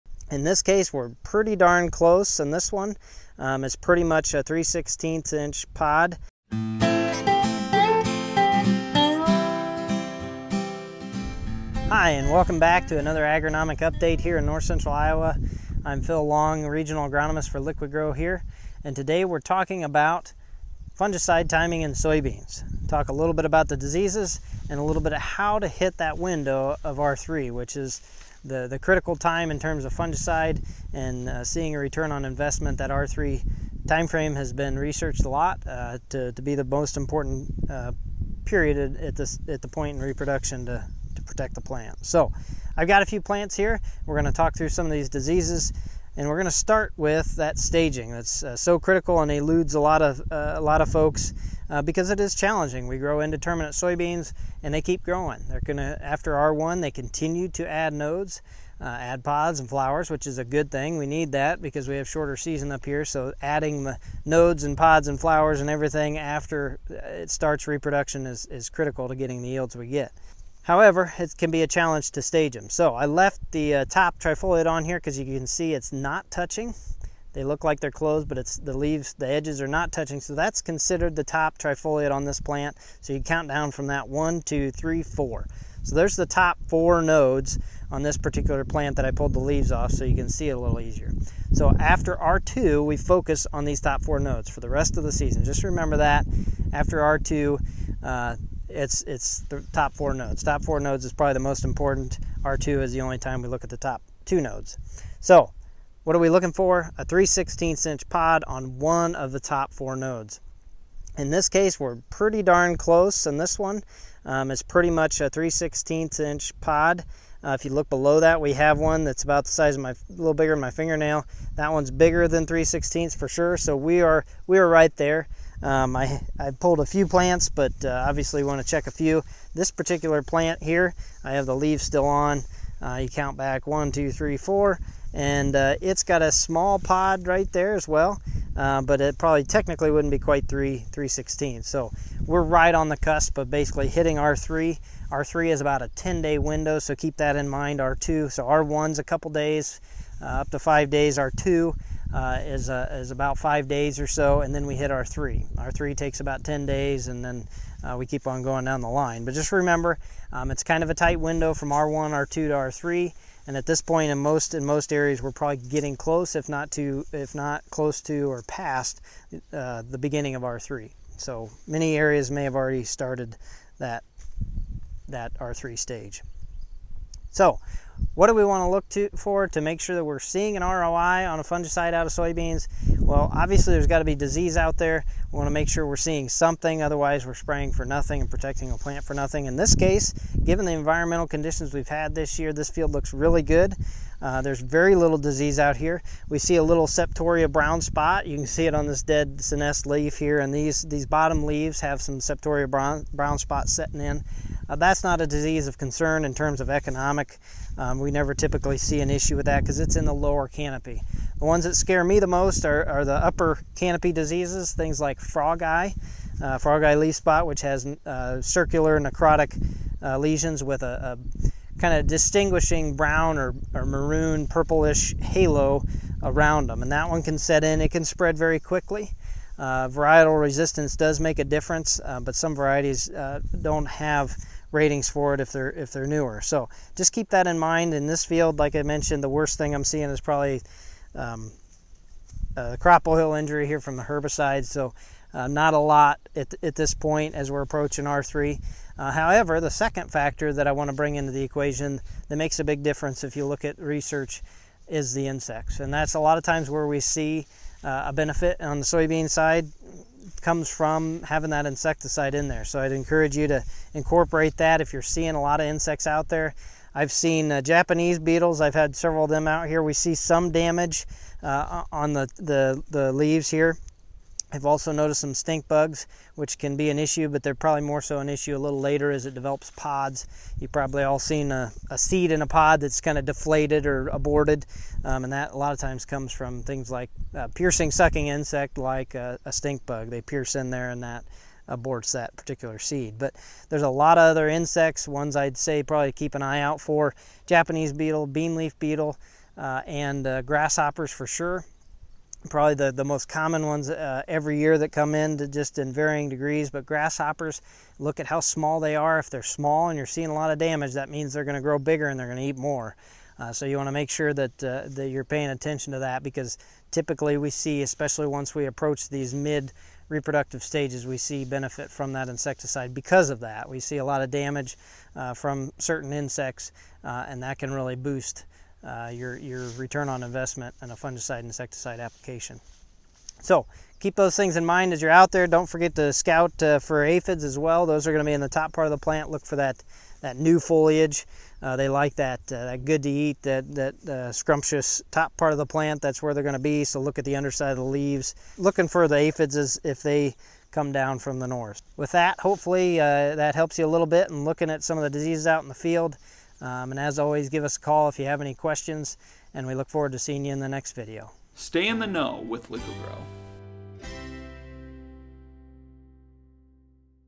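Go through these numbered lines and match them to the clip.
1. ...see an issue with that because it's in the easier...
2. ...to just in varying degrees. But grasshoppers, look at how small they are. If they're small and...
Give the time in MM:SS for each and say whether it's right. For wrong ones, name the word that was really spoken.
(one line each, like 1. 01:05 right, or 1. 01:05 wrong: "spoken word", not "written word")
1. 03:28 wrong: "lower", not "easier"
2. 05:05 right.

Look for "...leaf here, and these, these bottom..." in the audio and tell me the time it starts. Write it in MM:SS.
03:19.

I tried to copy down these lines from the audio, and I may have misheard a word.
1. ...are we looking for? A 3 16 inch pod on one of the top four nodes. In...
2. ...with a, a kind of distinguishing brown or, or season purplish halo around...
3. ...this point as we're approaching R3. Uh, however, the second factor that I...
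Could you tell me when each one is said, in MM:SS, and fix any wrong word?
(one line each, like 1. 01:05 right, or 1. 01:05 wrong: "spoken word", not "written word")
1. 01:46 right
2. 03:40 wrong: "maroon", not "season"
3. 04:06 right.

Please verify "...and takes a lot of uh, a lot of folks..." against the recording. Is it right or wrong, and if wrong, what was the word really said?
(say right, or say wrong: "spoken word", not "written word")
wrong: "eludes", not "takes".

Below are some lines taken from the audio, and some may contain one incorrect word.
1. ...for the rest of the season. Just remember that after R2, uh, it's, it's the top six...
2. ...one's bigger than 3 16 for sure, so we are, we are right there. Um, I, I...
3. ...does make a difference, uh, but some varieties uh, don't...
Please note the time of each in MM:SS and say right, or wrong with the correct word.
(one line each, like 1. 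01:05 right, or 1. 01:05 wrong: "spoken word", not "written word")
1. 01:34 wrong: "four", not "six"
2. 02:01 right
3. 03:50 right.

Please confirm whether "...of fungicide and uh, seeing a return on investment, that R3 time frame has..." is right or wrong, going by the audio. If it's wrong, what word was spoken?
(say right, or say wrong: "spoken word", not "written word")
right.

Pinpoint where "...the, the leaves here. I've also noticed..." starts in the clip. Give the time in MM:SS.
04:32.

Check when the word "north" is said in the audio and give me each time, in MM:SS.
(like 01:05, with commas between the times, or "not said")
00:14, 05:51.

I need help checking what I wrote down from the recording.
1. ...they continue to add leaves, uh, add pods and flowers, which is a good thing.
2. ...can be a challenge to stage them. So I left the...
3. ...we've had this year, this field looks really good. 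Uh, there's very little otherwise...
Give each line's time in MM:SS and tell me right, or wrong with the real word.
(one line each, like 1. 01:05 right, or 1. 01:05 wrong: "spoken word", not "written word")
1. 00:56 wrong: "nodes", not "leaves"
2. 01:11 right
3. 03:11 wrong: "disease", not "otherwise".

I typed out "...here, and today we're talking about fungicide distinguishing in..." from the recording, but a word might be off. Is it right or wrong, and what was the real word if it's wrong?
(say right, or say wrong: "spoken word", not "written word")
wrong: "timing", not "distinguishing".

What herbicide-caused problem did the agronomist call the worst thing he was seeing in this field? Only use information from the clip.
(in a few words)
Crop oil injury.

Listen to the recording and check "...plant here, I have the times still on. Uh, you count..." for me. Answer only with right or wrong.
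wrong.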